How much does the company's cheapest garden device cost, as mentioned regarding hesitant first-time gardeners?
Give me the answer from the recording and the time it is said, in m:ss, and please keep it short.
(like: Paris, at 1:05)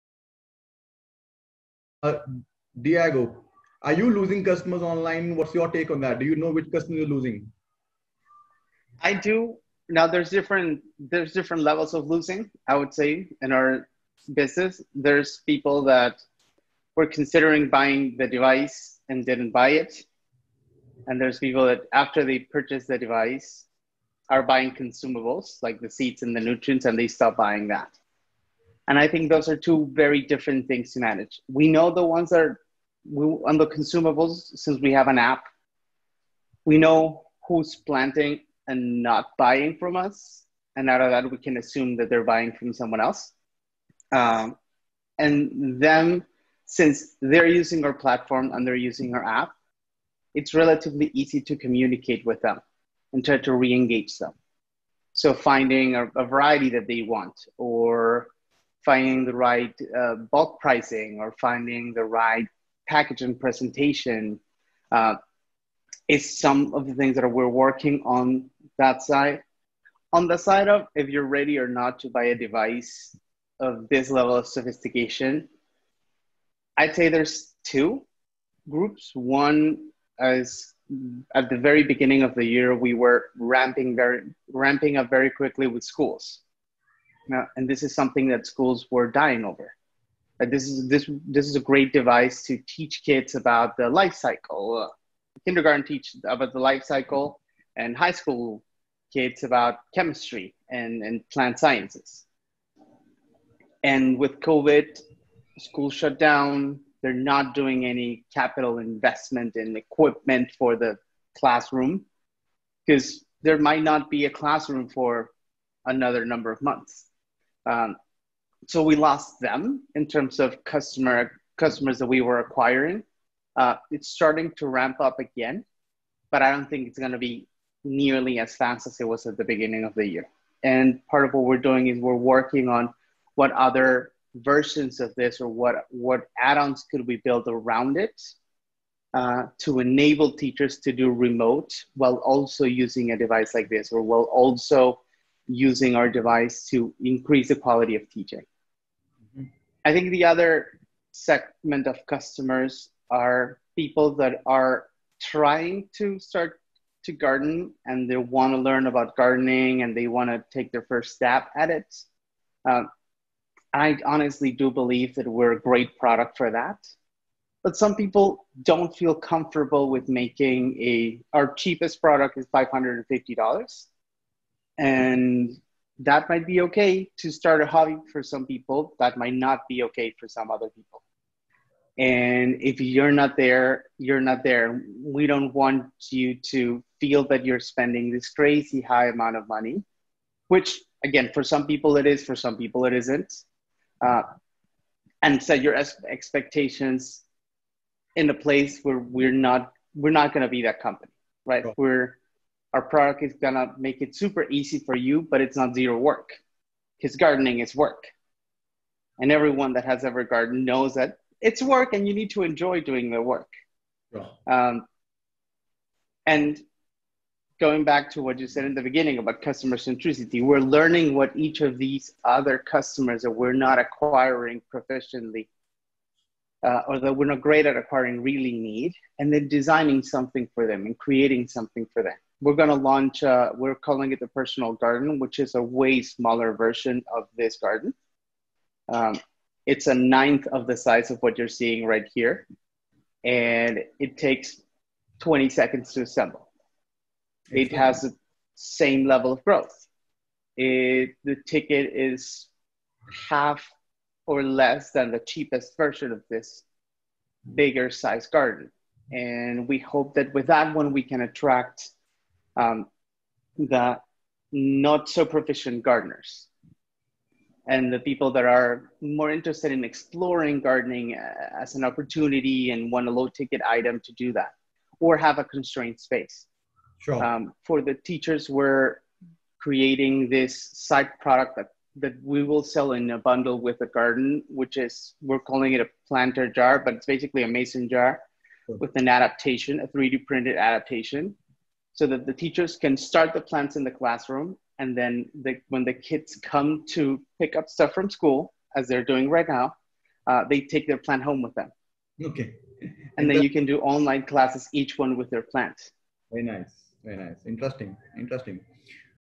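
$550, at 2:52.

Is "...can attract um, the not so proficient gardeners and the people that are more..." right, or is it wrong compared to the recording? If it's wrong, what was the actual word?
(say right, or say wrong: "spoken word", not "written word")
right.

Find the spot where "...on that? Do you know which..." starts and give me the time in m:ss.
0:05.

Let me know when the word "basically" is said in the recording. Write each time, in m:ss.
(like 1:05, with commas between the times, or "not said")
4:47.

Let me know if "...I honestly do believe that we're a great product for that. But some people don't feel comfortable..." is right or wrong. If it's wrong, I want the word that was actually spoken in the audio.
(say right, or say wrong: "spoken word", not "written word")
right.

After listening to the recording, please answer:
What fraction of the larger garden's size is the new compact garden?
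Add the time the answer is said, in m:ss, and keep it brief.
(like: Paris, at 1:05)
a ninth, at 3:59.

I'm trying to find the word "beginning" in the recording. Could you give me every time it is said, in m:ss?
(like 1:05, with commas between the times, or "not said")
1:21, 2:09, 3:38.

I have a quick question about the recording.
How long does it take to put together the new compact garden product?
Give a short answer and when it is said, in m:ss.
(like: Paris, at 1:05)
20 seconds, at 4:05.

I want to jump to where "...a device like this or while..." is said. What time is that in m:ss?
2:23.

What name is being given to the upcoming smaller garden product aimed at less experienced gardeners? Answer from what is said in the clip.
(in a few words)
personal garden.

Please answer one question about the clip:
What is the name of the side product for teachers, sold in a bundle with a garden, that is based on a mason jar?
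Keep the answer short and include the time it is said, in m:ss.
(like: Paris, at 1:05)
planter jar, at 4:46.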